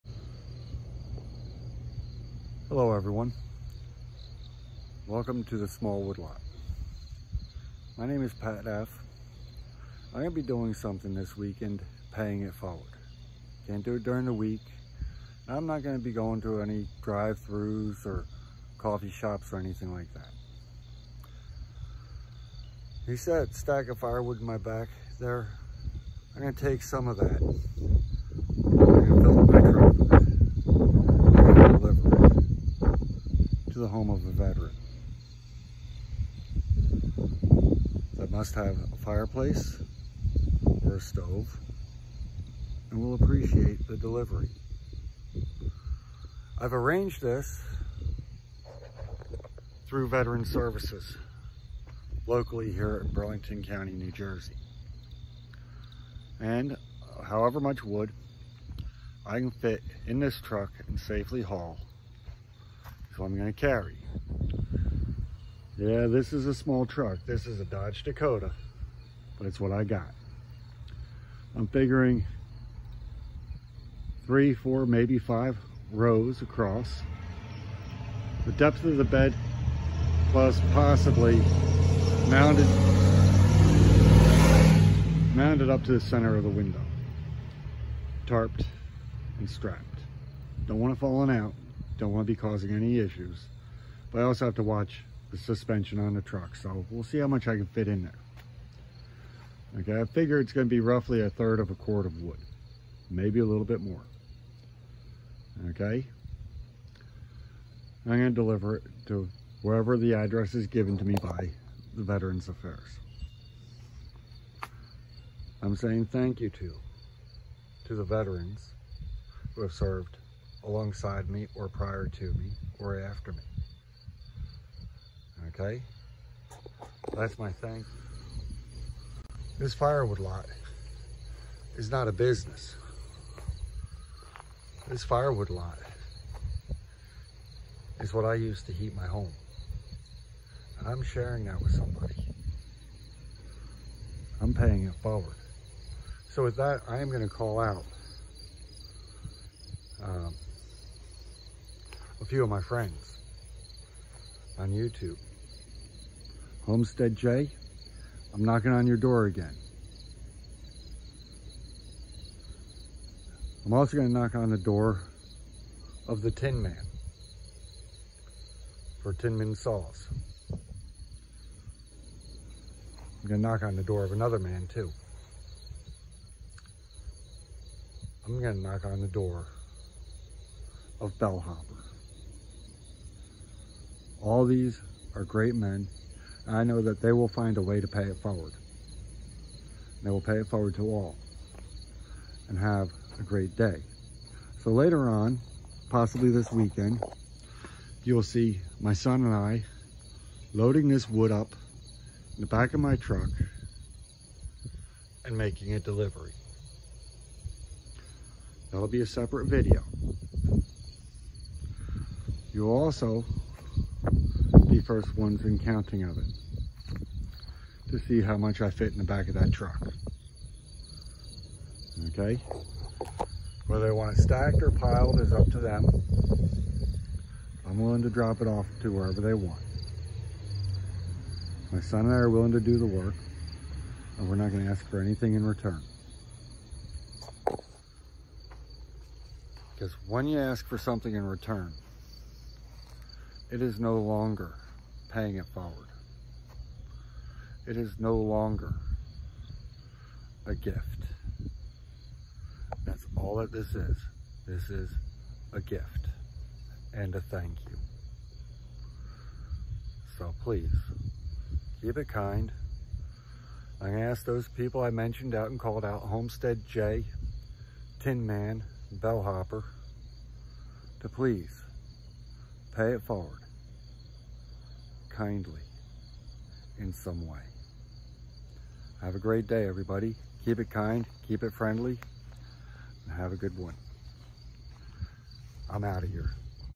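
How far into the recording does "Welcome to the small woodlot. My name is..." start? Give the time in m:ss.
0:05.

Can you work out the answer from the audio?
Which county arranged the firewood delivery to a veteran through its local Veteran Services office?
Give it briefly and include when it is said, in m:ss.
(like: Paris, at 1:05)
Burlington County, at 0:53.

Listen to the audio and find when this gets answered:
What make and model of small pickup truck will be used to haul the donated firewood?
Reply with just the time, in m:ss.
1:07.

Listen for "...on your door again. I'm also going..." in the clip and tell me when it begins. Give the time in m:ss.
2:38.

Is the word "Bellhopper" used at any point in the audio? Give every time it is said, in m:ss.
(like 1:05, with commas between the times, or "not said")
3:01, 4:28.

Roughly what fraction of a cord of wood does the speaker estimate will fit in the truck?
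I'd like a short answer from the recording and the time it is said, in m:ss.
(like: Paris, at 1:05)
A third, at 1:41.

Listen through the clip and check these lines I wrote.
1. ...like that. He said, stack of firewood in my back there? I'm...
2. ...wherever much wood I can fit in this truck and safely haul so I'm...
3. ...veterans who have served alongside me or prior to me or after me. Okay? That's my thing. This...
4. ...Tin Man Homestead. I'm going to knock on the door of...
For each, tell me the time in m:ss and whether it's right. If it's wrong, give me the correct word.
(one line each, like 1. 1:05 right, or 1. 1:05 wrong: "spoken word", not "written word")
1. 0:19 right
2. 0:57 wrong: "however", not "wherever"
3. 1:58 right
4. 2:49 wrong: "Sauce", not "Homestead".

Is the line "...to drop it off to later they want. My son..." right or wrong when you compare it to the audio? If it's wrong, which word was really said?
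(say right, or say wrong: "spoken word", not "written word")
wrong: "wherever", not "later".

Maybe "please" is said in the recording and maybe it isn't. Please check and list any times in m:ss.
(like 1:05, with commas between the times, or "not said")
4:20, 4:31.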